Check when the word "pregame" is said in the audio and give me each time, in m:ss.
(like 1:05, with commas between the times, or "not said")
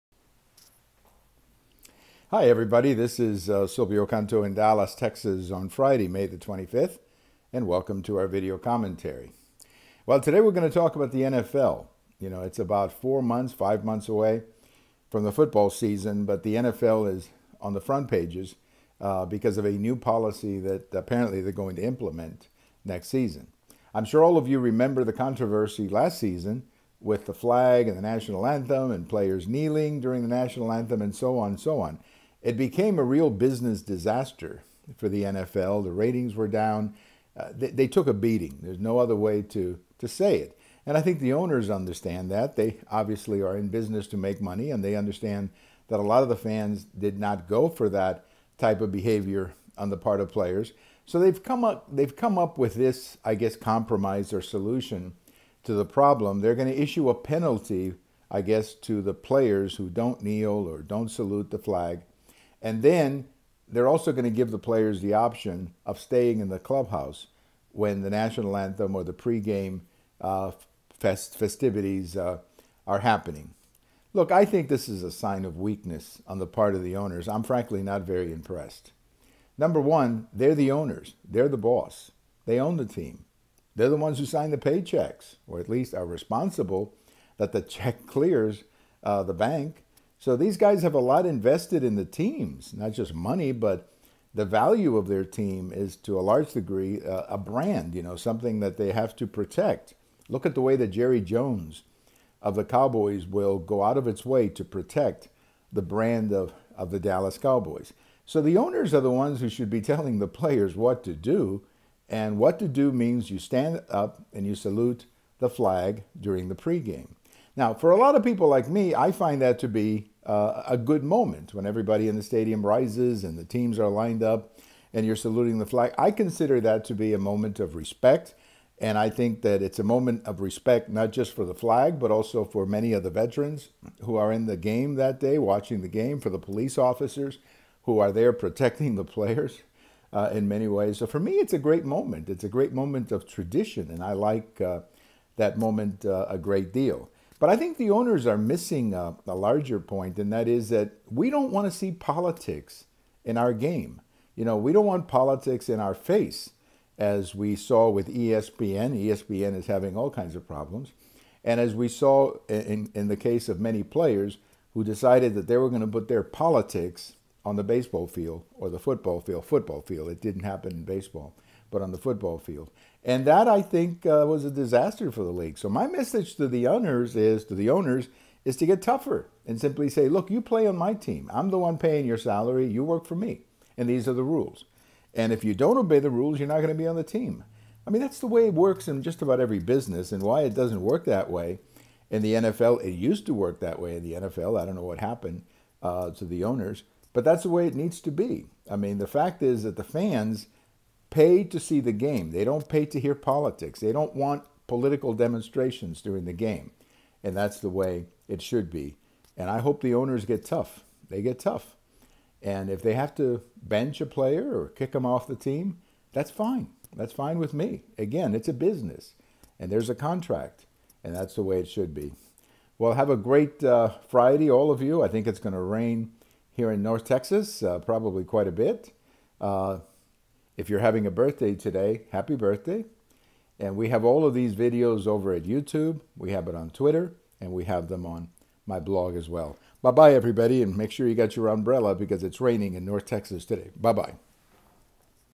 1:09, 1:56.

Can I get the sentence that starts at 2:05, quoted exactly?
I consider that to be a moment of respect.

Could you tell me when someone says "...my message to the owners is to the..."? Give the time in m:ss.
2:55.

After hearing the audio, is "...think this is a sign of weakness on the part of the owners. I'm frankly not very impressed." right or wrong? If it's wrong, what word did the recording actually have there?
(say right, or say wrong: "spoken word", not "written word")
right.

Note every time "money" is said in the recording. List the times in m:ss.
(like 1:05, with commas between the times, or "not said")
0:44, 1:33.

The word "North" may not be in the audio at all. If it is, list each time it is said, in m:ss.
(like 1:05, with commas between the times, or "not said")
3:46, 4:02.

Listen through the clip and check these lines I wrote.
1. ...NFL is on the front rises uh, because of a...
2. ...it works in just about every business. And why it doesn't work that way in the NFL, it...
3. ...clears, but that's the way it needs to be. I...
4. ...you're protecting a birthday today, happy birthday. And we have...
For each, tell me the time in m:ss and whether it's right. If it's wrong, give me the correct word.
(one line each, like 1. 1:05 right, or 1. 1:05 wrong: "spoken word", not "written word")
1. 0:16 wrong: "pages", not "rises"
2. 3:08 right
3. 3:16 wrong: "owners", not "clears"
4. 3:50 wrong: "having", not "protecting".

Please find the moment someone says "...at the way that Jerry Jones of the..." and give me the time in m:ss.
1:40.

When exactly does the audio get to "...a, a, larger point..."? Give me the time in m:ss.
2:28.